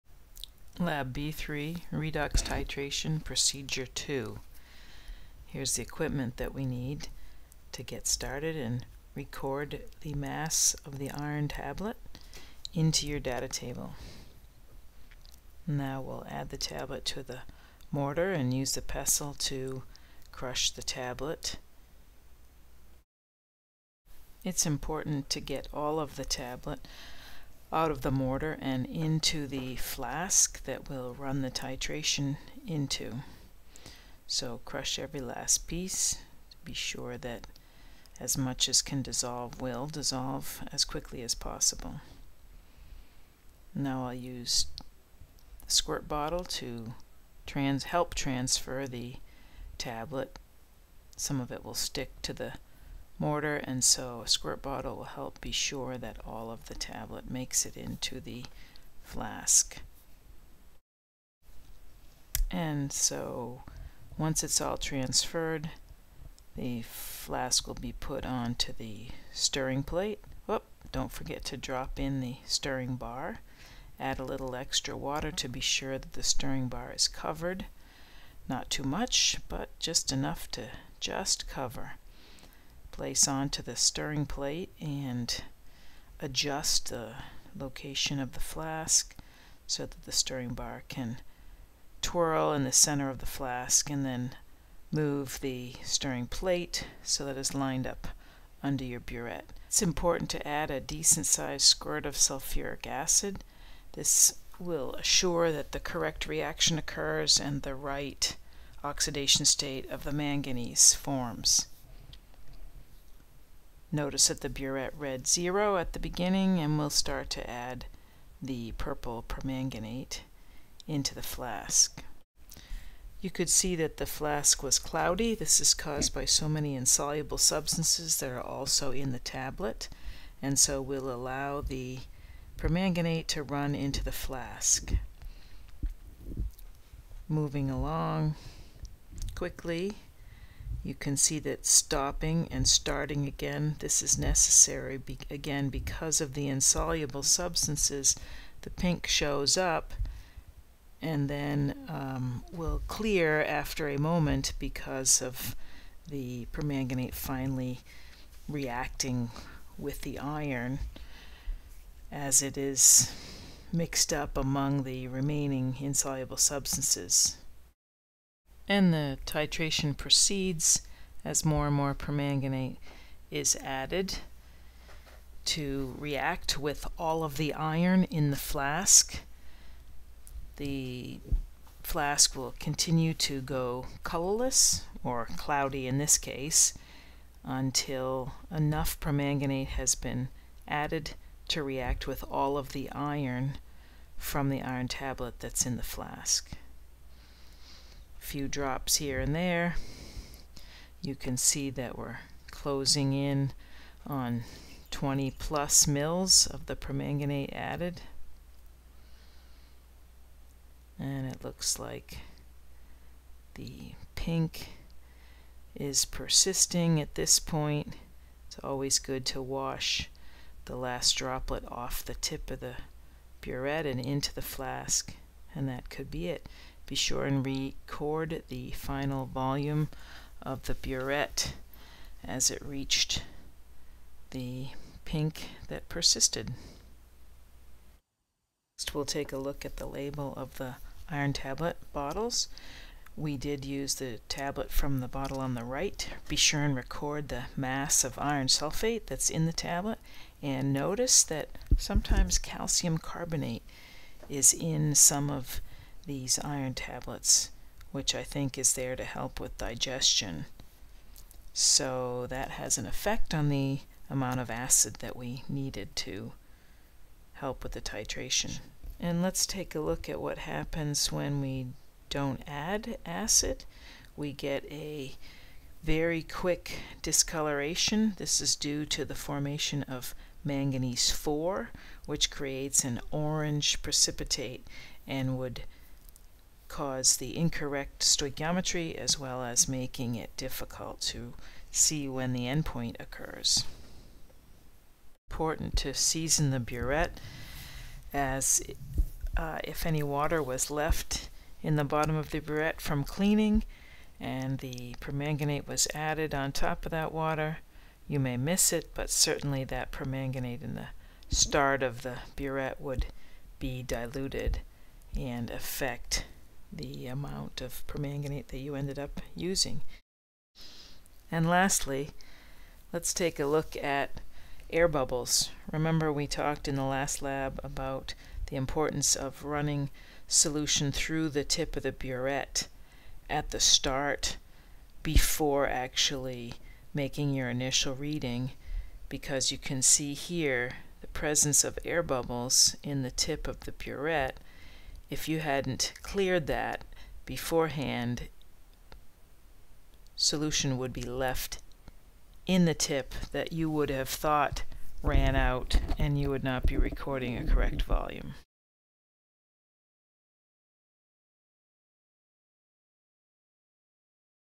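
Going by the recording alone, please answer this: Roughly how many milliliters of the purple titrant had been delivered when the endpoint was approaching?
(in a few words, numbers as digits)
20+ mL.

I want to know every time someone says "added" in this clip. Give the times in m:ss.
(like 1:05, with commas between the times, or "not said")
2:53, 3:10, 3:27, 5:05.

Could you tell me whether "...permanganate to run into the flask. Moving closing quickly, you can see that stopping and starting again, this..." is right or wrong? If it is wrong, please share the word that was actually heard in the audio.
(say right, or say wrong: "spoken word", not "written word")
wrong: "along", not "closing".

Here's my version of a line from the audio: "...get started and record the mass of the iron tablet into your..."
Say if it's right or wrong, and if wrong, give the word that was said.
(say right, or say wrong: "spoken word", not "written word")
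right.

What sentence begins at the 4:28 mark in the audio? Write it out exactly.
And let's take a look at what happens when we don't add acid.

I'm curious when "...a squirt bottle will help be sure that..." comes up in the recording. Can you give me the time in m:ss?
0:54.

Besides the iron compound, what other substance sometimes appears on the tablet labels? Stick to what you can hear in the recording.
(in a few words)
calcium carbonate.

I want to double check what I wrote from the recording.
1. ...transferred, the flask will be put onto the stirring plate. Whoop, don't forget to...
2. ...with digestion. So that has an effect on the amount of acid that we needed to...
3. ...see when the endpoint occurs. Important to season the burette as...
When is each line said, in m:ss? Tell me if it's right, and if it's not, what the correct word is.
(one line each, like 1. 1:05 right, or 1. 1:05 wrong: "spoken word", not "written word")
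1. 1:04 right
2. 4:19 right
3. 4:51 right.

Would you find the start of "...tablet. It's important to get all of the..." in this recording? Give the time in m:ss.
0:20.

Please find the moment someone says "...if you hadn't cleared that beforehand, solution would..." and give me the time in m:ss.
5:45.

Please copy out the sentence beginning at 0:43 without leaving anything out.
Now I'll use the squirt bottle to trans help transfer the tablet.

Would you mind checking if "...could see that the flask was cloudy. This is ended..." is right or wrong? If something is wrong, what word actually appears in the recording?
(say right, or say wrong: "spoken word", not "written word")
wrong: "caused", not "ended".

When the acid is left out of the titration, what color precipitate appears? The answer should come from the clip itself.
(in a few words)
orange.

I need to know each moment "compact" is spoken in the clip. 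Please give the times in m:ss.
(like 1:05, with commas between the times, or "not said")
not said.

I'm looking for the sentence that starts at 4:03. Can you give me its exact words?
We did use the tablet from the bottle on the right.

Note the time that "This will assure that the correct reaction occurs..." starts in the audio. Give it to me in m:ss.
1:43.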